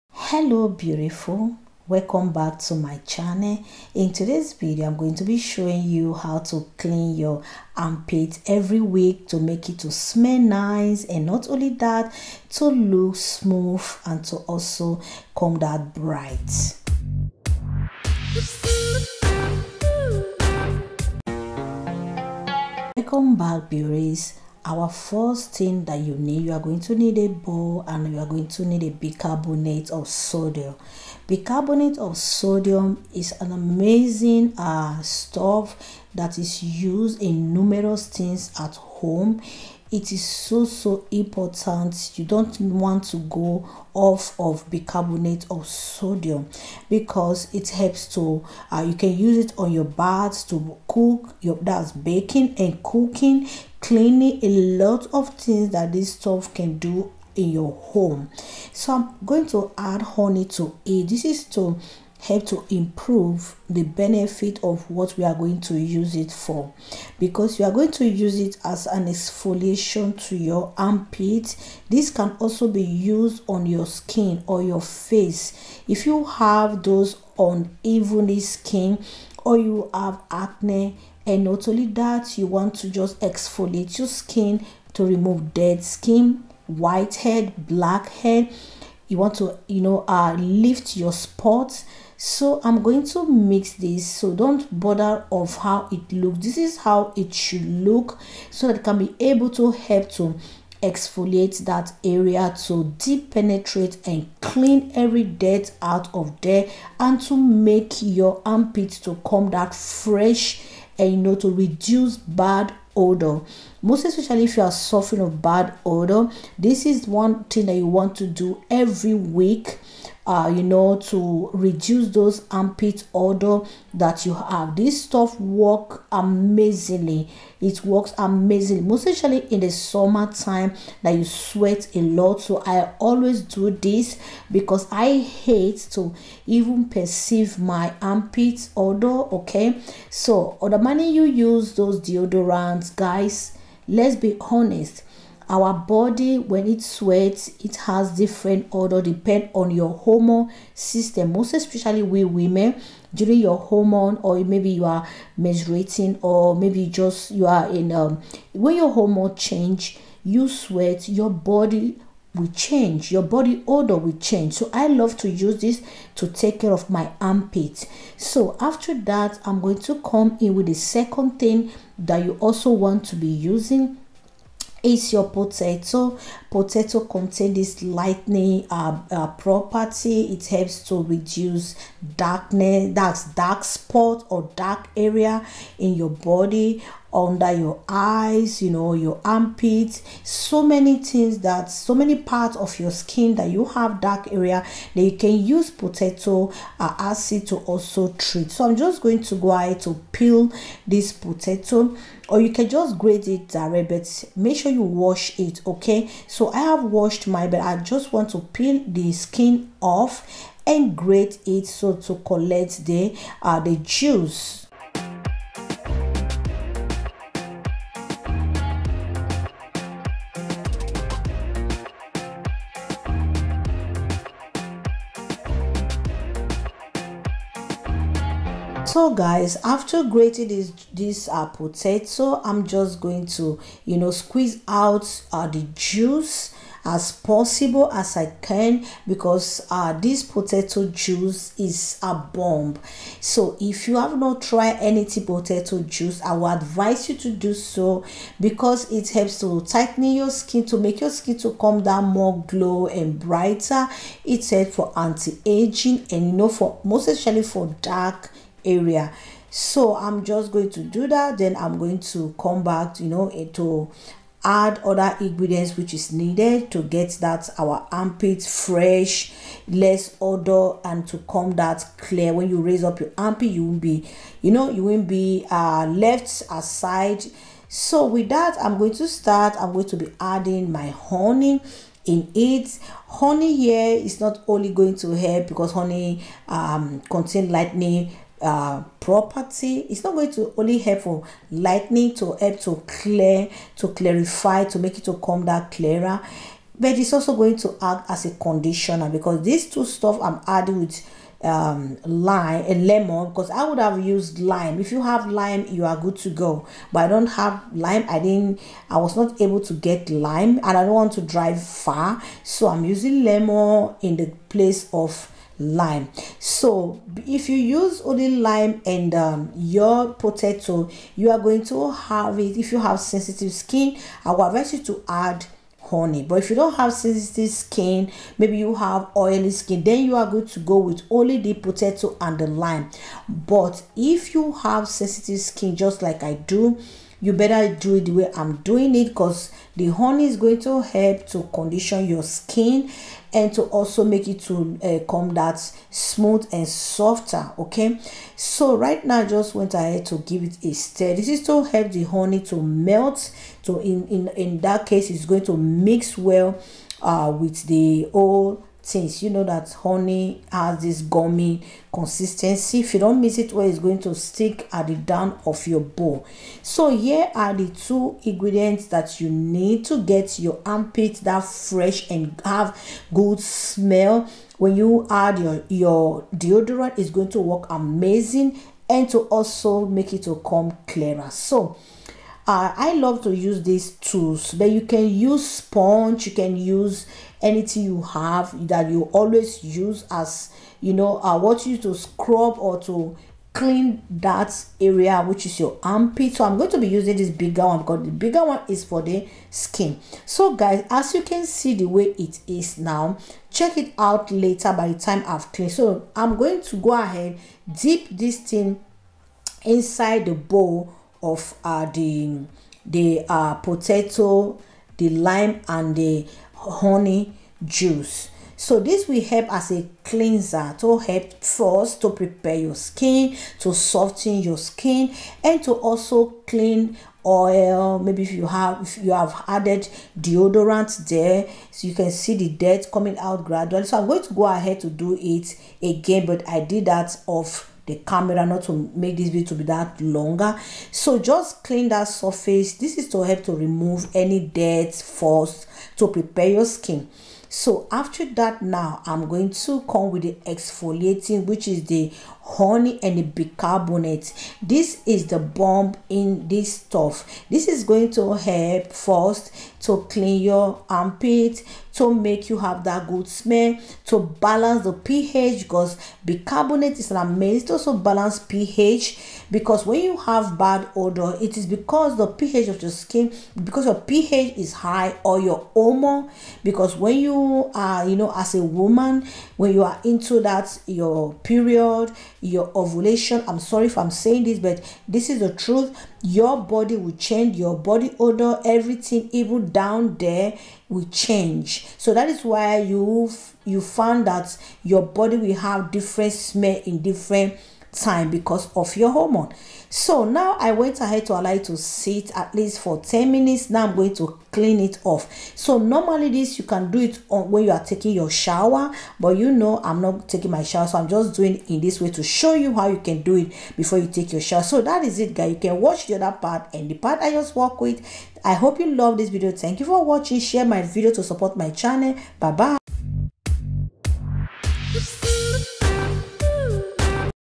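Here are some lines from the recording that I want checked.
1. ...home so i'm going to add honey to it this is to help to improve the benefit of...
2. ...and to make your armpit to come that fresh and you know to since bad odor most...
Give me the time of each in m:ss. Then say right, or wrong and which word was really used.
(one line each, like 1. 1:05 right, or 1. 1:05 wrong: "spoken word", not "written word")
1. 0:57 right
2. 1:46 wrong: "reduce", not "since".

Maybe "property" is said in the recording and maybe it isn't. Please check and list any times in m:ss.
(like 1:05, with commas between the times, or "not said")
2:59, 4:48.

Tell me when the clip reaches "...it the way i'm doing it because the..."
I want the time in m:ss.
5:37.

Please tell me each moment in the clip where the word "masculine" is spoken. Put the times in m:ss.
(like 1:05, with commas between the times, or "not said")
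not said.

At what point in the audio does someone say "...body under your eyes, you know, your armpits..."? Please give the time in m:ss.
3:06.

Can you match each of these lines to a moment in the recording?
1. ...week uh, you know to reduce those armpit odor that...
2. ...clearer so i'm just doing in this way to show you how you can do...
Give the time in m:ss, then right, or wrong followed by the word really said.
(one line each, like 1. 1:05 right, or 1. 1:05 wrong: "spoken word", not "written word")
1. 1:59 right
2. 8:30 wrong: "shower", not "clearer".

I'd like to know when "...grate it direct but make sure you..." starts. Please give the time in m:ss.
3:22.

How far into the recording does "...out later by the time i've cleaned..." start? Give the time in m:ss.
6:43.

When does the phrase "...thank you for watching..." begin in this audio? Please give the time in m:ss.
8:39.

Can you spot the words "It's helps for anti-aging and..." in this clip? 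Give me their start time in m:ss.
4:14.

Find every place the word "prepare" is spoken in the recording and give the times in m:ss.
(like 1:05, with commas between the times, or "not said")
7:02, 7:26.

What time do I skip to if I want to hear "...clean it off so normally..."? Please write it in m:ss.
8:24.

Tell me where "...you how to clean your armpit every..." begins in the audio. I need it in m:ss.
0:05.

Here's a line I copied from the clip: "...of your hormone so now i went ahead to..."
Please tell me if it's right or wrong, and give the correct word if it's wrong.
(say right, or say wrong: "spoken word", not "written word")
right.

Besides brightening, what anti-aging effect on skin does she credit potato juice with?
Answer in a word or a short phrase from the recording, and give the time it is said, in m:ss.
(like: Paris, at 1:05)
tighten your skin, at 4:09.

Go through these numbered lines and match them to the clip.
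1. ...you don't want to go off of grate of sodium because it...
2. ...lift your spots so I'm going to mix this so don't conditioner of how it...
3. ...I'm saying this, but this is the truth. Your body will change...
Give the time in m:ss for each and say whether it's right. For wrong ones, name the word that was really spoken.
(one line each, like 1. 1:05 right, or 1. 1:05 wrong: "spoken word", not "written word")
1. 0:42 wrong: "bicarbonate", not "grate"
2. 1:30 wrong: "bother", not "conditioner"
3. 8:03 right.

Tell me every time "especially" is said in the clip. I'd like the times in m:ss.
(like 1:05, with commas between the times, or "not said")
1:54, 2:09, 2:31, 4:17.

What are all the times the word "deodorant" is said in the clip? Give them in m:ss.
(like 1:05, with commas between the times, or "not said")
2:21, 6:16, 7:10.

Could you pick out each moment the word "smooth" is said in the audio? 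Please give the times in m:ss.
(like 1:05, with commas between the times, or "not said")
0:13, 5:45.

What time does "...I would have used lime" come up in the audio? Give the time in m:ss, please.
5:03.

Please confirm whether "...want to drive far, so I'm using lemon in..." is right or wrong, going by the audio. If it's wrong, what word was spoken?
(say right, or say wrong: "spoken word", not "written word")
right.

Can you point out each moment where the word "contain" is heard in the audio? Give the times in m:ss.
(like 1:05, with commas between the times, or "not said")
2:57, 4:47.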